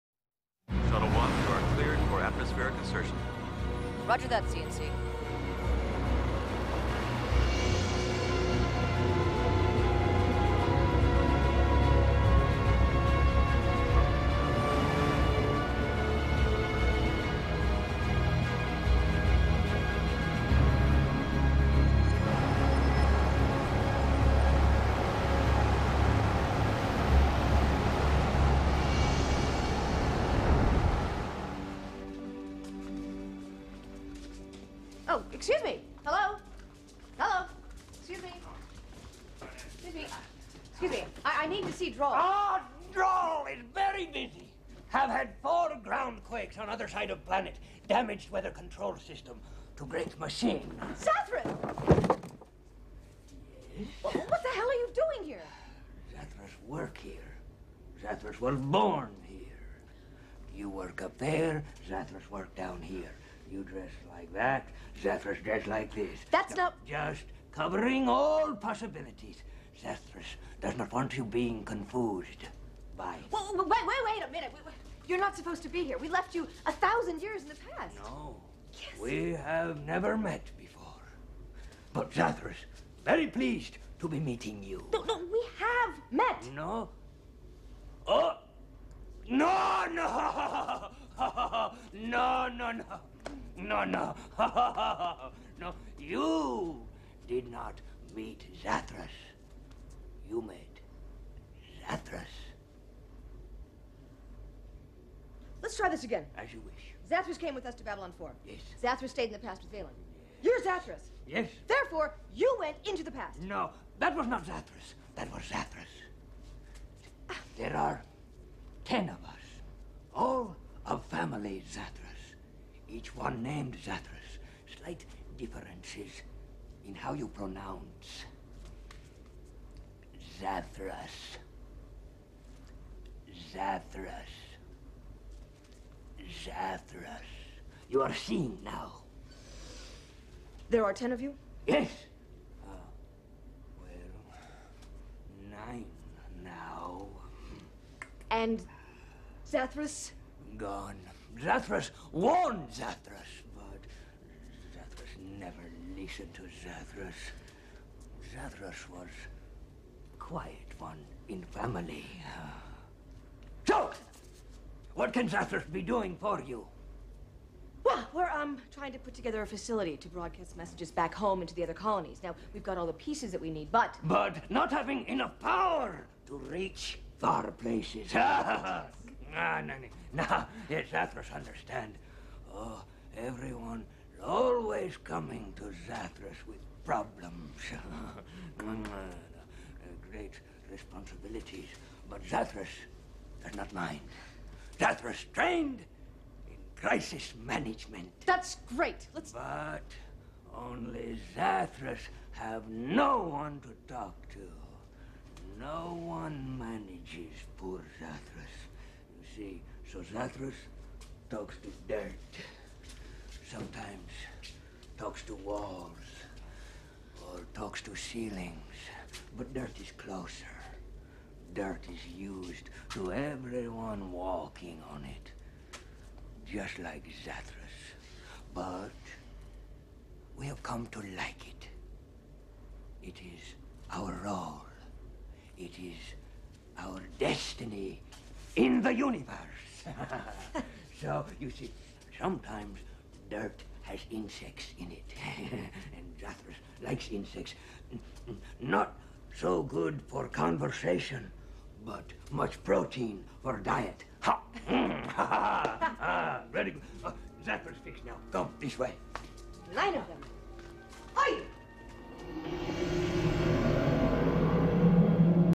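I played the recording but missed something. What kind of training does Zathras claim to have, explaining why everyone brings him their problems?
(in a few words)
Crisis management.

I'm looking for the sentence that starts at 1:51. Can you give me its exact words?
Therefore, you went into the past.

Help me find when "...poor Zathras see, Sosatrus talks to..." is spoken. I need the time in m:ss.
3:27.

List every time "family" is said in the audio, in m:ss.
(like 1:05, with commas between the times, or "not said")
2:01, 2:41.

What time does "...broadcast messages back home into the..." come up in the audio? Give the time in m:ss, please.
2:50.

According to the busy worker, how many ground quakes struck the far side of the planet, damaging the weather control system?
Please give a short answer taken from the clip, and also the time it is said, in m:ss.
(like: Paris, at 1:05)
4, at 0:45.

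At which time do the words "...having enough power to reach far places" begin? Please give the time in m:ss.
2:54.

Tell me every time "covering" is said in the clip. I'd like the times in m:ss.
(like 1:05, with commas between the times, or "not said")
1:07.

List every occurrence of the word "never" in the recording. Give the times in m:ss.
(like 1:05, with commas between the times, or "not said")
1:19, 2:35.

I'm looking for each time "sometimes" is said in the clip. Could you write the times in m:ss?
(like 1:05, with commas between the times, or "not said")
3:33, 4:02.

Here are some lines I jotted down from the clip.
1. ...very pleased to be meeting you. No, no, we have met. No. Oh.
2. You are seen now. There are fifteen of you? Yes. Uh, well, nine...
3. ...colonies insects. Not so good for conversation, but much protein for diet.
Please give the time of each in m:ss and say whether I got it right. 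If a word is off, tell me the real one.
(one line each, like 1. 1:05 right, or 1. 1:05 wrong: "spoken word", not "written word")
1. 1:23 right
2. 2:17 wrong: "ten", not "fifteen"
3. 4:06 wrong: "likes", not "colonies".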